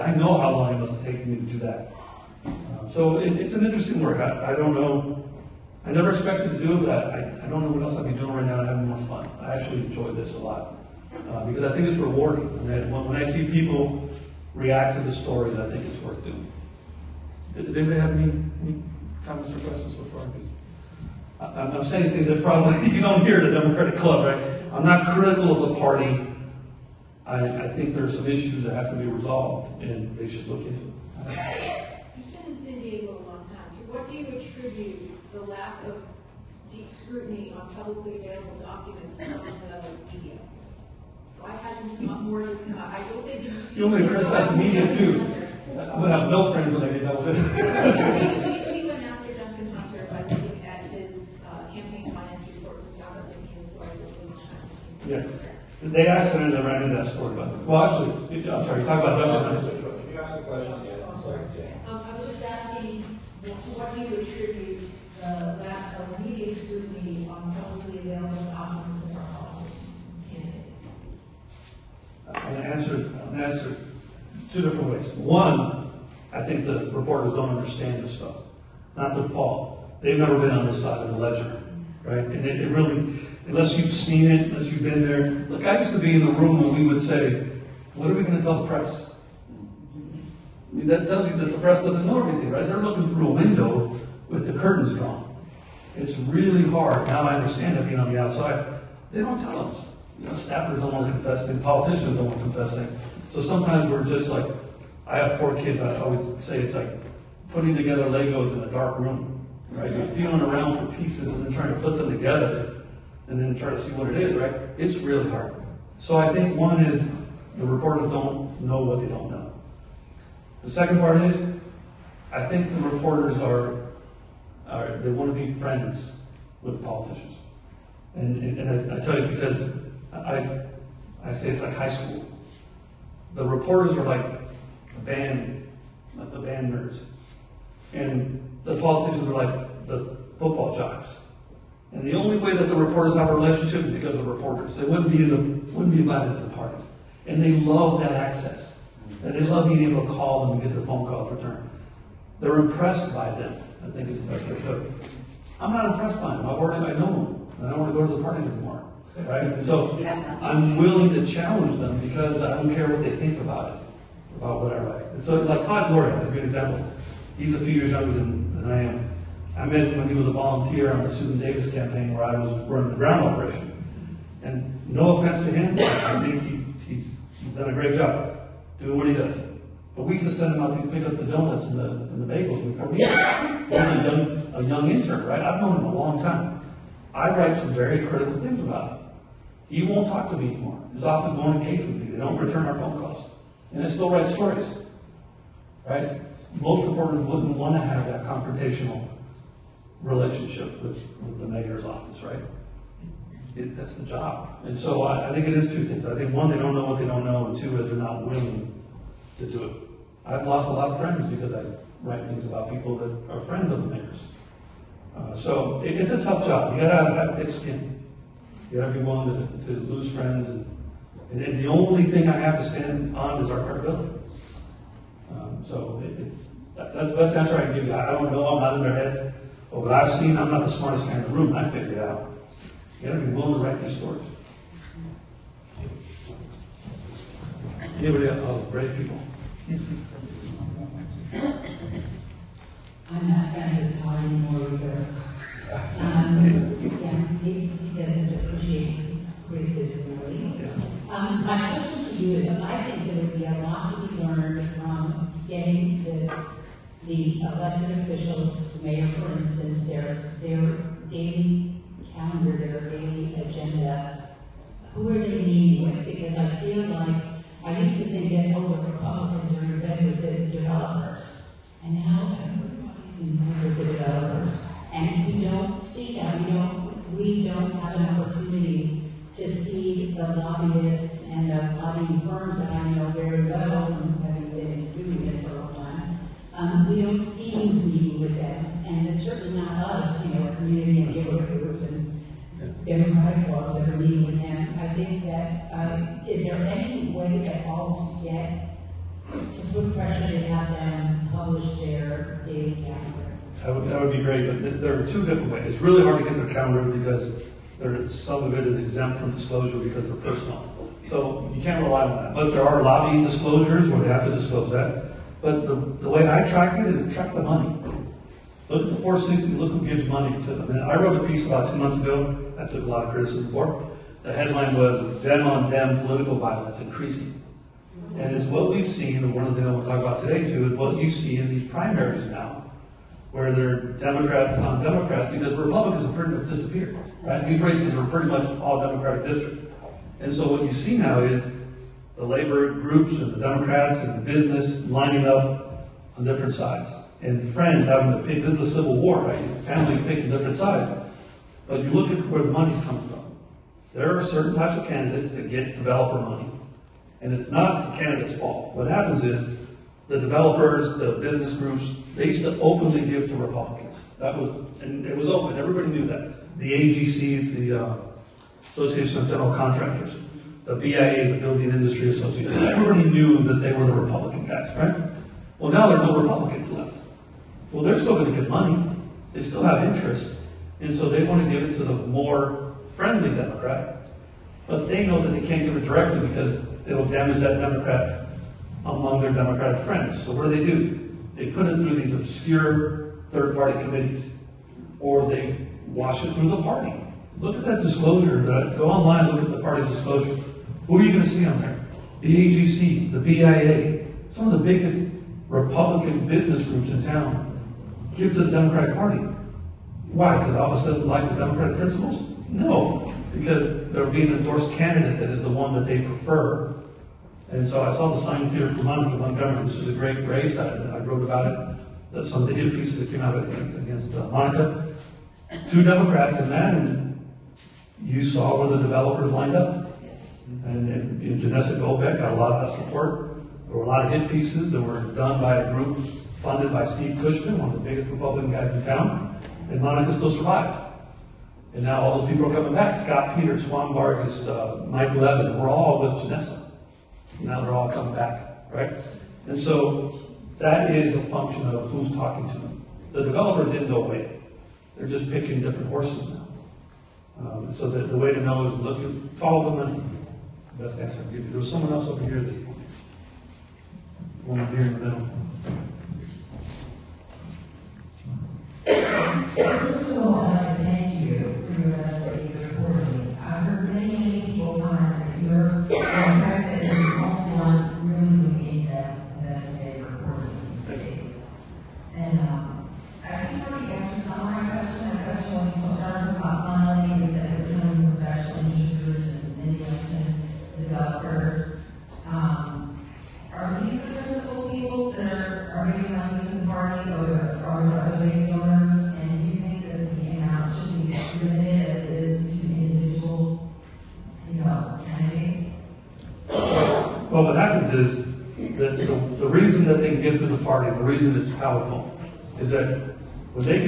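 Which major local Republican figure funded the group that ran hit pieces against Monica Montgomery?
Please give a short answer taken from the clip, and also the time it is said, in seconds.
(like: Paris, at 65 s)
Steve Cushman, at 436 s.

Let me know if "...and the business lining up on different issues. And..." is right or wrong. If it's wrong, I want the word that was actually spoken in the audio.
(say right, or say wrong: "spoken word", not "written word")
wrong: "sides", not "issues".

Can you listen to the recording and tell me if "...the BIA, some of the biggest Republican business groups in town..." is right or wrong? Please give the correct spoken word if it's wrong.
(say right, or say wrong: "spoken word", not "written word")
right.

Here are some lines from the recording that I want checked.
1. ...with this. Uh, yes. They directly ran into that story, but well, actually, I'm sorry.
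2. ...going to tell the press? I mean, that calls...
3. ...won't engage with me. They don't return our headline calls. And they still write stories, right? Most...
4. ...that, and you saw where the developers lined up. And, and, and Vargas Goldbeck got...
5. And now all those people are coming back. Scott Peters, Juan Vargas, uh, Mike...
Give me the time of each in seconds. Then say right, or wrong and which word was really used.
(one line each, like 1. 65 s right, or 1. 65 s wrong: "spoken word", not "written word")
1. 47 s wrong: "accidentally", not "directly"
2. 88 s wrong: "tells", not "calls"
3. 191 s wrong: "phone", not "headline"
4. 426 s wrong: "Janessa", not "Vargas"
5. 441 s right.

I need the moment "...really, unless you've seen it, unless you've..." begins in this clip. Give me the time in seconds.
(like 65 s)
82 s.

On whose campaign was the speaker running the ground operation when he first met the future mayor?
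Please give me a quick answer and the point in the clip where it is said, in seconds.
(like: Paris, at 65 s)
Susan Davis, at 171 s.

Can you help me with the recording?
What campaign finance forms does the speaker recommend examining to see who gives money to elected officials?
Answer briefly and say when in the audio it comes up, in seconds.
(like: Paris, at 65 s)
460s, at 319 s.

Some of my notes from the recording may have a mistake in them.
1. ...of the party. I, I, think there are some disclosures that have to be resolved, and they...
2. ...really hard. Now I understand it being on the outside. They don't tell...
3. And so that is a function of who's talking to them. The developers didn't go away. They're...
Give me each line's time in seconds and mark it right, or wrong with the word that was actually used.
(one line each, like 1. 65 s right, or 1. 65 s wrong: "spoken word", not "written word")
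1. 25 s wrong: "issues", not "disclosures"
2. 96 s right
3. 449 s right.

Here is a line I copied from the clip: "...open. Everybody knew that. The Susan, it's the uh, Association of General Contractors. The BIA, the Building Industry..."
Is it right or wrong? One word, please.
wrong.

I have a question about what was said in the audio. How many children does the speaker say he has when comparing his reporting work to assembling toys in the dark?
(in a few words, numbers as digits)
4.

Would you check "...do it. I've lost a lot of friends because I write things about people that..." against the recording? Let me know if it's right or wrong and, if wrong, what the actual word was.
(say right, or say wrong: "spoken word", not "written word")
right.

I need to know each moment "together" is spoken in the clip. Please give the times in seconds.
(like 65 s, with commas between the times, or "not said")
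107 s, 112 s.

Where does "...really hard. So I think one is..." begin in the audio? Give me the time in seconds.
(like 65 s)
114 s.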